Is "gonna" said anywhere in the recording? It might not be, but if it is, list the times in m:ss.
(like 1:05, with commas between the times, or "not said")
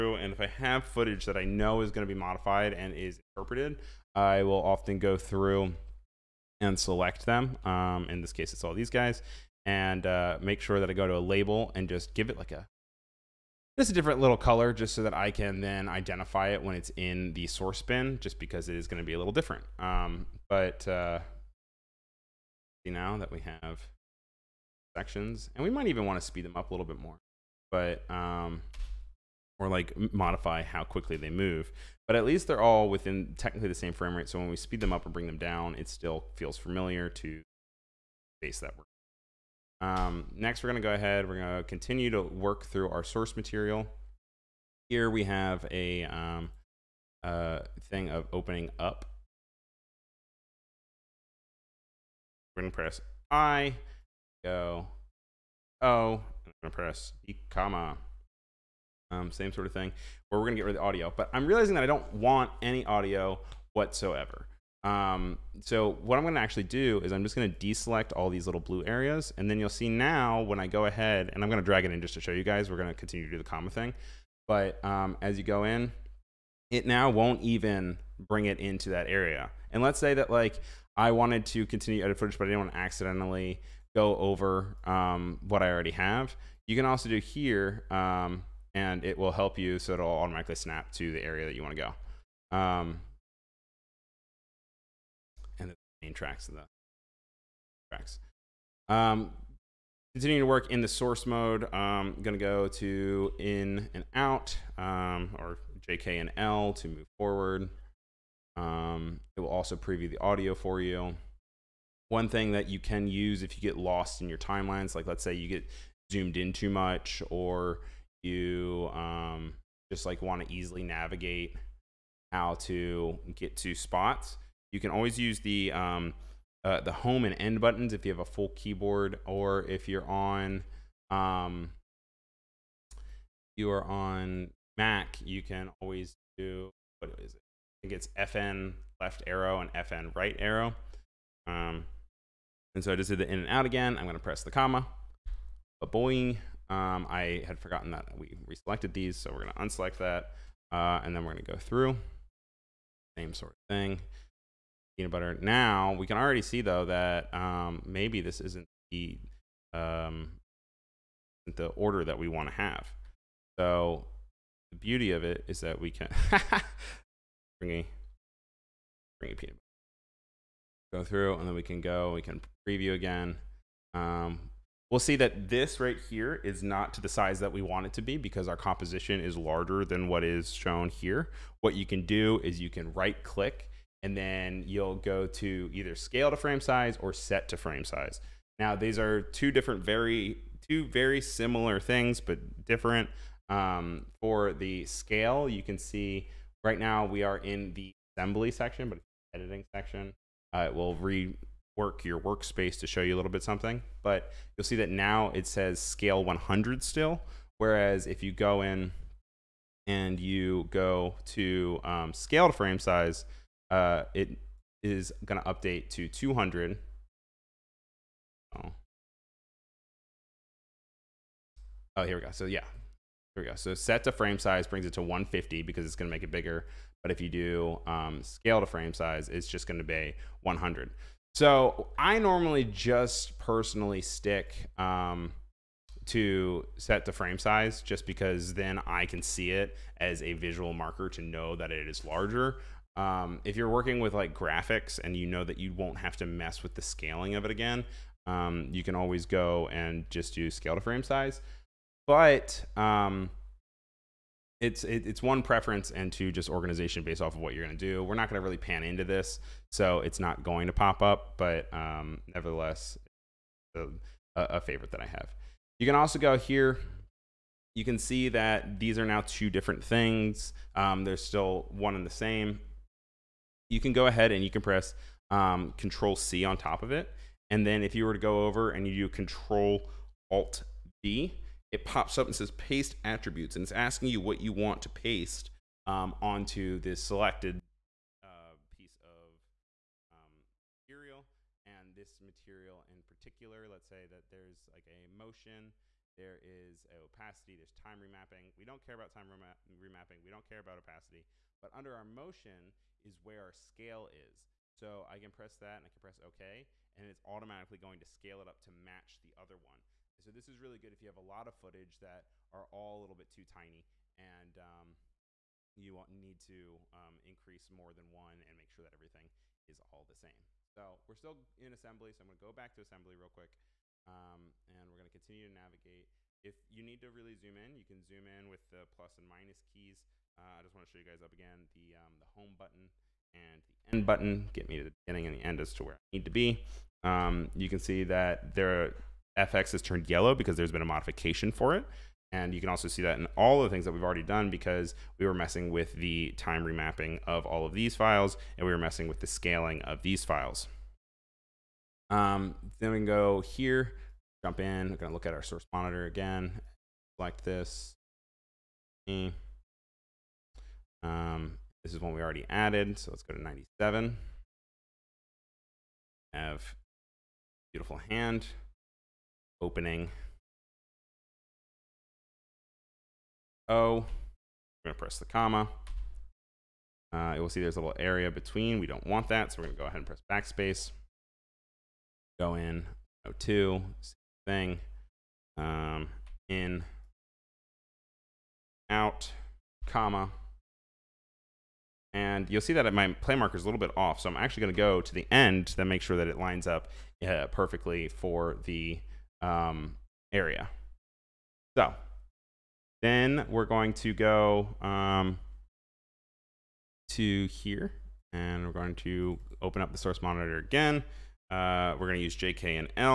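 5:54, 6:14, 6:19.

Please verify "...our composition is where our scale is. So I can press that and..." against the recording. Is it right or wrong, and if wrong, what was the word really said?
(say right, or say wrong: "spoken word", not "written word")
wrong: "motion", not "composition".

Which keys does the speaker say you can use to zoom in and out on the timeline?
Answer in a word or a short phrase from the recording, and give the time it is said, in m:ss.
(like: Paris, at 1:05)
plus and minus, at 5:28.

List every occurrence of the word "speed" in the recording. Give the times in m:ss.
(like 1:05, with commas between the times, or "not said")
0:26, 0:34.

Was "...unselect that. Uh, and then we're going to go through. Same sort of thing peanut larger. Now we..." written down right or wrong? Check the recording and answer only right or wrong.
wrong.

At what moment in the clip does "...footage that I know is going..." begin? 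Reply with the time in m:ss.
0:00.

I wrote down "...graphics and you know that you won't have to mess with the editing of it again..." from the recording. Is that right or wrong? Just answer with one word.
wrong.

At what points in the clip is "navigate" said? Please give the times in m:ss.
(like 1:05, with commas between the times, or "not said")
2:00, 5:25.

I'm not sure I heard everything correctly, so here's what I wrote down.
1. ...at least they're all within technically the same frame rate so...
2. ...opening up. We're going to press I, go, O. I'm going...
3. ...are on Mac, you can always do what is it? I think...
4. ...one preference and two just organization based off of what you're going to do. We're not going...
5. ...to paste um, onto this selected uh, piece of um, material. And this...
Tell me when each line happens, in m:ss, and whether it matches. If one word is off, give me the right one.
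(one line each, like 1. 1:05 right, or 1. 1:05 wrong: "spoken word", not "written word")
1. 0:32 right
2. 0:48 right
3. 2:13 right
4. 4:15 right
5. 4:44 right.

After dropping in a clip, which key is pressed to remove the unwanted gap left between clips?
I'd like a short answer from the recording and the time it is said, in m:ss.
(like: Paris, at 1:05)
Backspace, at 6:20.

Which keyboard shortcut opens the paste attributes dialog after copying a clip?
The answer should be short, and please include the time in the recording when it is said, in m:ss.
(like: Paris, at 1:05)
Control Alt B, at 4:39.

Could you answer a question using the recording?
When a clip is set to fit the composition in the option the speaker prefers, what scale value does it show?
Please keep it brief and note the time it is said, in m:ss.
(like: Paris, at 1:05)
150, at 3:45.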